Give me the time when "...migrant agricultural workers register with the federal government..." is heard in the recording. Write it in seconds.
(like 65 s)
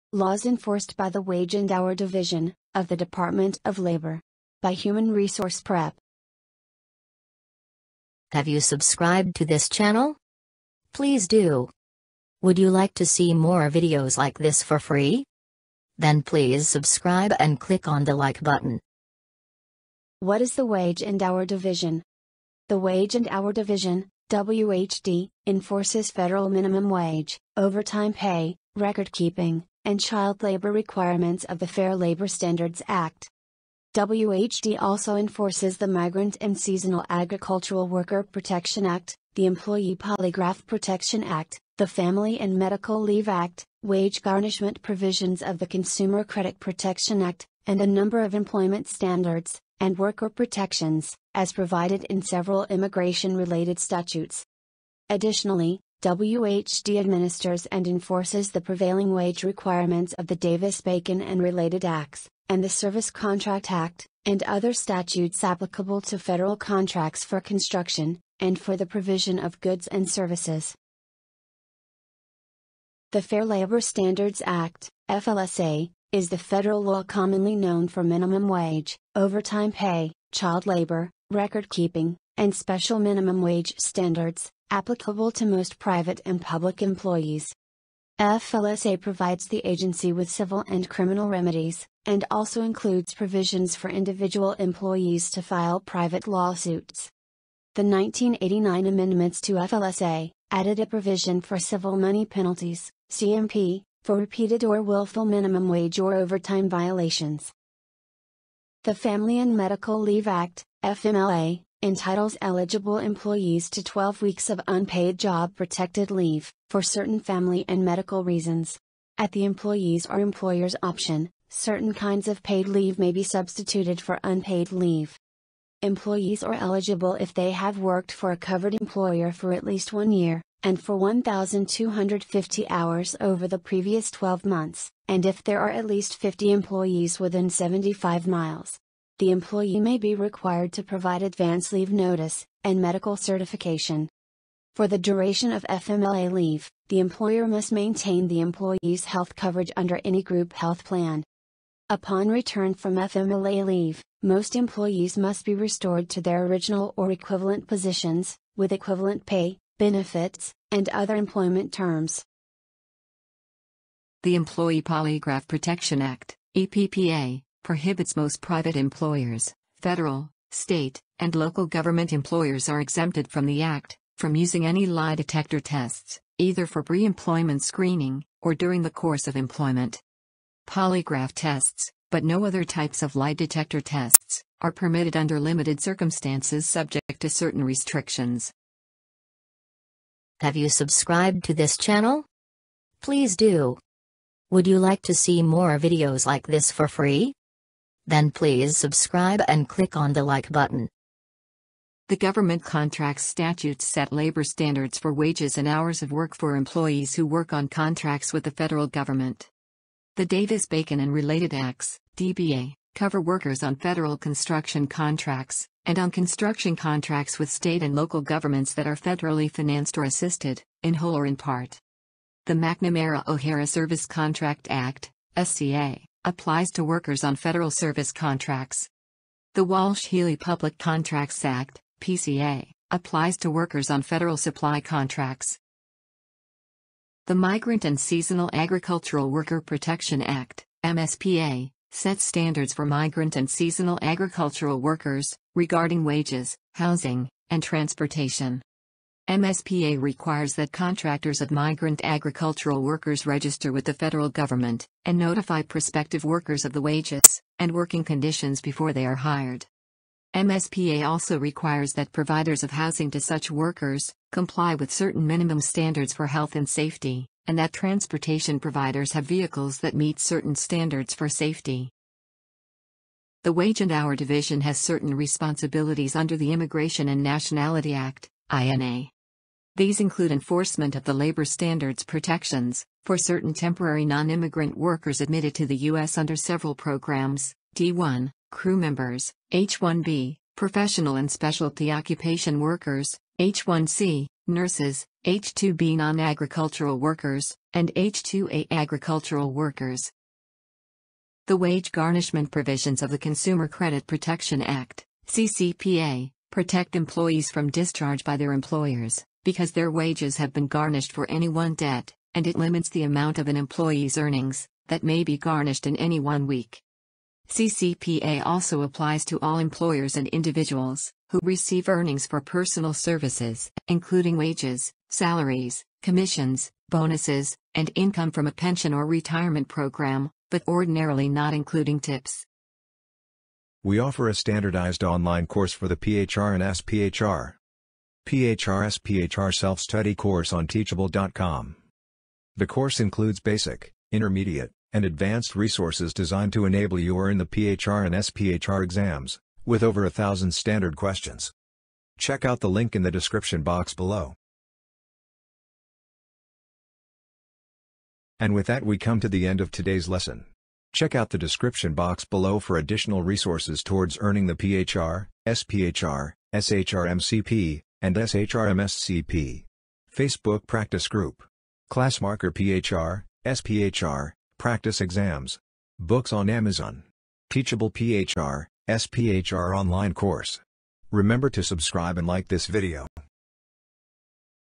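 251 s.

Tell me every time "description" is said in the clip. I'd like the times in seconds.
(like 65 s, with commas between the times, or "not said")
353 s, 361 s.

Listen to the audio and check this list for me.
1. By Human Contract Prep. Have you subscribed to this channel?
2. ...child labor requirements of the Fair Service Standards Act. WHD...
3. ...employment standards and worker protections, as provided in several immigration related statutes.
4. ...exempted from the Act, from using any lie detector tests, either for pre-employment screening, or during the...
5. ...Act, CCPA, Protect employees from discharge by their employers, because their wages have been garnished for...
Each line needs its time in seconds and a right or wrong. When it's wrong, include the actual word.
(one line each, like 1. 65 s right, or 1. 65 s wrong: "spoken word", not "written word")
1. 4 s wrong: "Resource", not "Contract"
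2. 29 s wrong: "Labor", not "Service"
3. 48 s right
4. 172 s right
5. 304 s right.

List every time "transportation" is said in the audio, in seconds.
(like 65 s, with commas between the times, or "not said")
247 s, 267 s.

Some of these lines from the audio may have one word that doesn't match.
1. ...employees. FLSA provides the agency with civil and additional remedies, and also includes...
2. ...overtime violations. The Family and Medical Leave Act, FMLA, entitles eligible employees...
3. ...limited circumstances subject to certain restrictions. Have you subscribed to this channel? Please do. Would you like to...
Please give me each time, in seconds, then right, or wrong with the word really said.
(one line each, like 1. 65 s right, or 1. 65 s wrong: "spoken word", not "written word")
1. 86 s wrong: "criminal", not "additional"
2. 106 s right
3. 185 s right.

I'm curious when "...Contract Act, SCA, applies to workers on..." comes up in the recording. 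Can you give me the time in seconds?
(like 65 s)
224 s.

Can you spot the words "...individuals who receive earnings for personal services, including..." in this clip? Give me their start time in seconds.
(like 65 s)
320 s.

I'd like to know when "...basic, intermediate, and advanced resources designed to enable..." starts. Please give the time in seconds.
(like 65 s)
343 s.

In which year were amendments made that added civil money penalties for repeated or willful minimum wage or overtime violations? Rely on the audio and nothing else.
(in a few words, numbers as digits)
1989.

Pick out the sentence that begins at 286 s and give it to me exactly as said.
under several programs, D1, crew members, H-1B, professional and specialty occupation workers, H-1C, nurses, H-2B non-agricultural workers, and H-2A agricultural workers.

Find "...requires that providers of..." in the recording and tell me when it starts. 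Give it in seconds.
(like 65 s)
261 s.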